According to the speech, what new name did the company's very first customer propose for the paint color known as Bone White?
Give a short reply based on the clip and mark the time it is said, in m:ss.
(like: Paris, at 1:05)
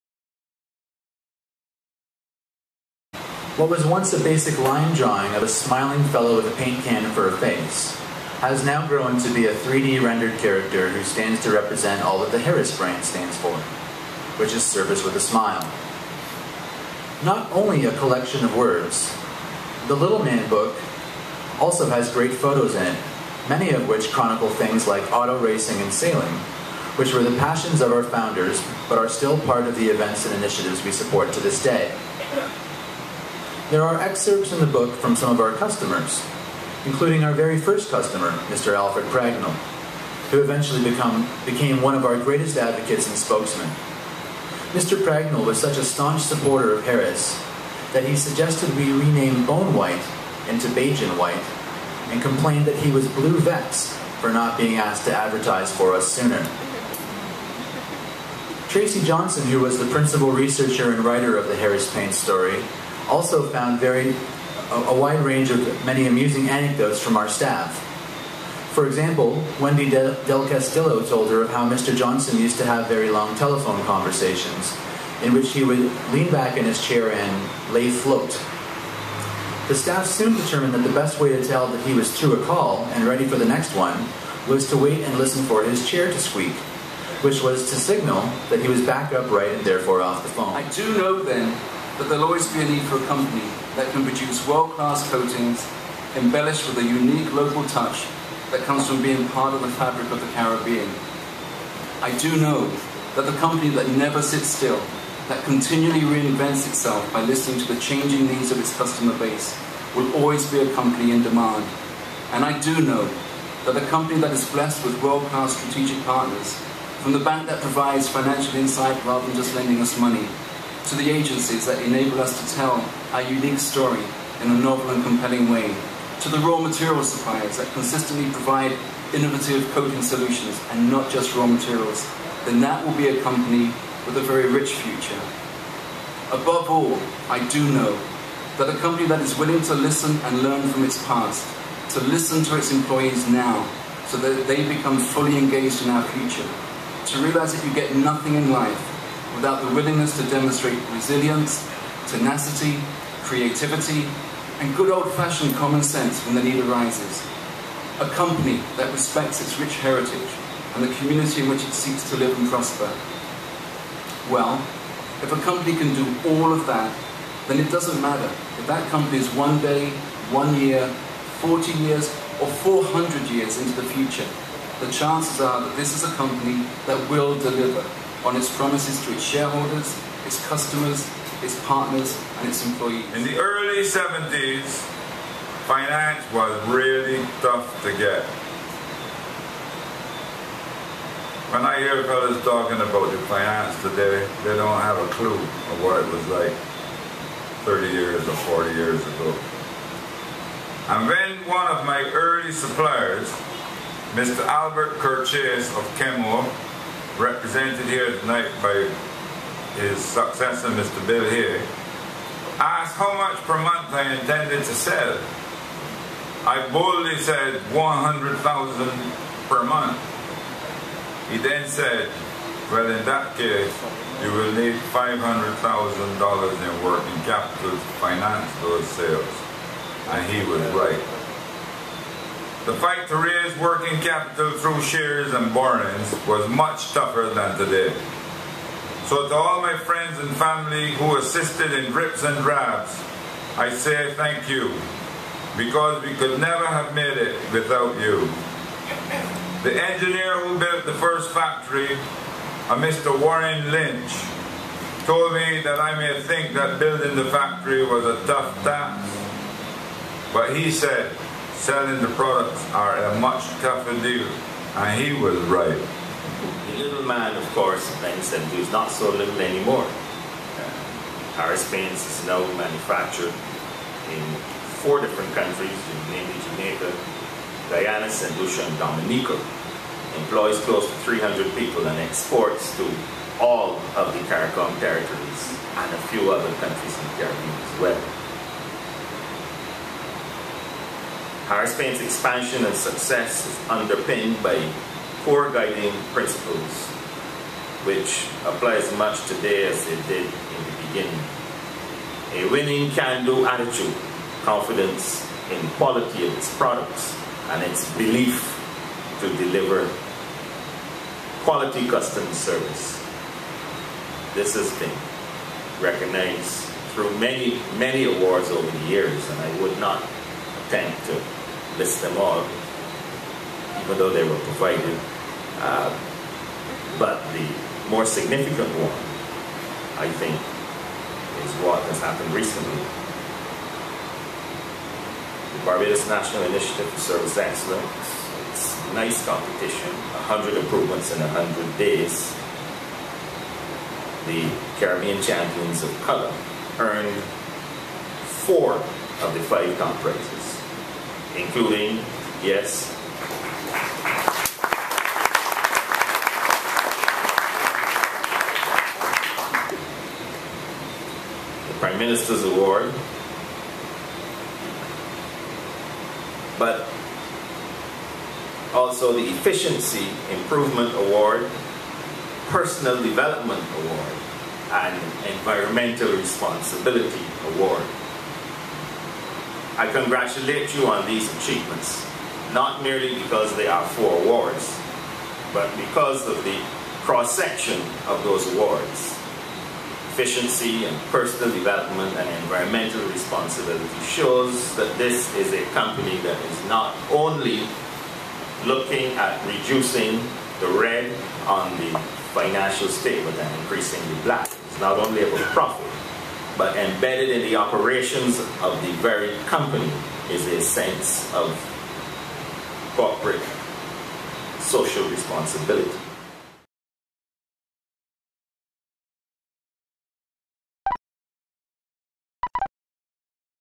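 Bajan White, at 0:50.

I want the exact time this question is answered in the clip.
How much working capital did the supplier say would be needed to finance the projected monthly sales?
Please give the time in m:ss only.
3:44.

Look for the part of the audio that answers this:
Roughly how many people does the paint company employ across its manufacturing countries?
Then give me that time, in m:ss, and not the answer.
4:41.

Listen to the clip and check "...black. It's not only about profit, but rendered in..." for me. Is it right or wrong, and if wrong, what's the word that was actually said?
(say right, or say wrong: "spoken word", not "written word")
wrong: "embedded", not "rendered".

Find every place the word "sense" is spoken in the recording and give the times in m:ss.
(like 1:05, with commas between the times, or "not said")
2:35, 6:50.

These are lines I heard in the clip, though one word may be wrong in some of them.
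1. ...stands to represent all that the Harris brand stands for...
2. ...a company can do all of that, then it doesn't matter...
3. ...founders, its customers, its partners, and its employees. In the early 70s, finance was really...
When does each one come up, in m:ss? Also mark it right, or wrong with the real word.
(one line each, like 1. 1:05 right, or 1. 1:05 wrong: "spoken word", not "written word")
1. 0:11 right
2. 2:45 right
3. 2:59 wrong: "shareholders", not "founders".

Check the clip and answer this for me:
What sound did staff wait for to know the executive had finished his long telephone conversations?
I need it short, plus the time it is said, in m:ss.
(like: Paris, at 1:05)
chair to squeak, at 1:25.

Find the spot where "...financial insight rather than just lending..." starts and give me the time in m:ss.
1:58.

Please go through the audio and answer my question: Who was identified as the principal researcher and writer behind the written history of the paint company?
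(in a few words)
Tracy Johnson.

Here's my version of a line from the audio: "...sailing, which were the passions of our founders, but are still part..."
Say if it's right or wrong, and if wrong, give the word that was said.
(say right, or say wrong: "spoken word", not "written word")
right.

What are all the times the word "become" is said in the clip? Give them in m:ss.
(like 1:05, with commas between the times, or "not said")
0:40, 2:24.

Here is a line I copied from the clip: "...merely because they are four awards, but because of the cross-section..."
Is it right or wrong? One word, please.
right.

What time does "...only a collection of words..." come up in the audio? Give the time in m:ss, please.
0:17.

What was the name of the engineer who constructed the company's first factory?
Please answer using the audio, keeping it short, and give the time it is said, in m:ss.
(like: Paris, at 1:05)
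Warren Lynch, at 4:13.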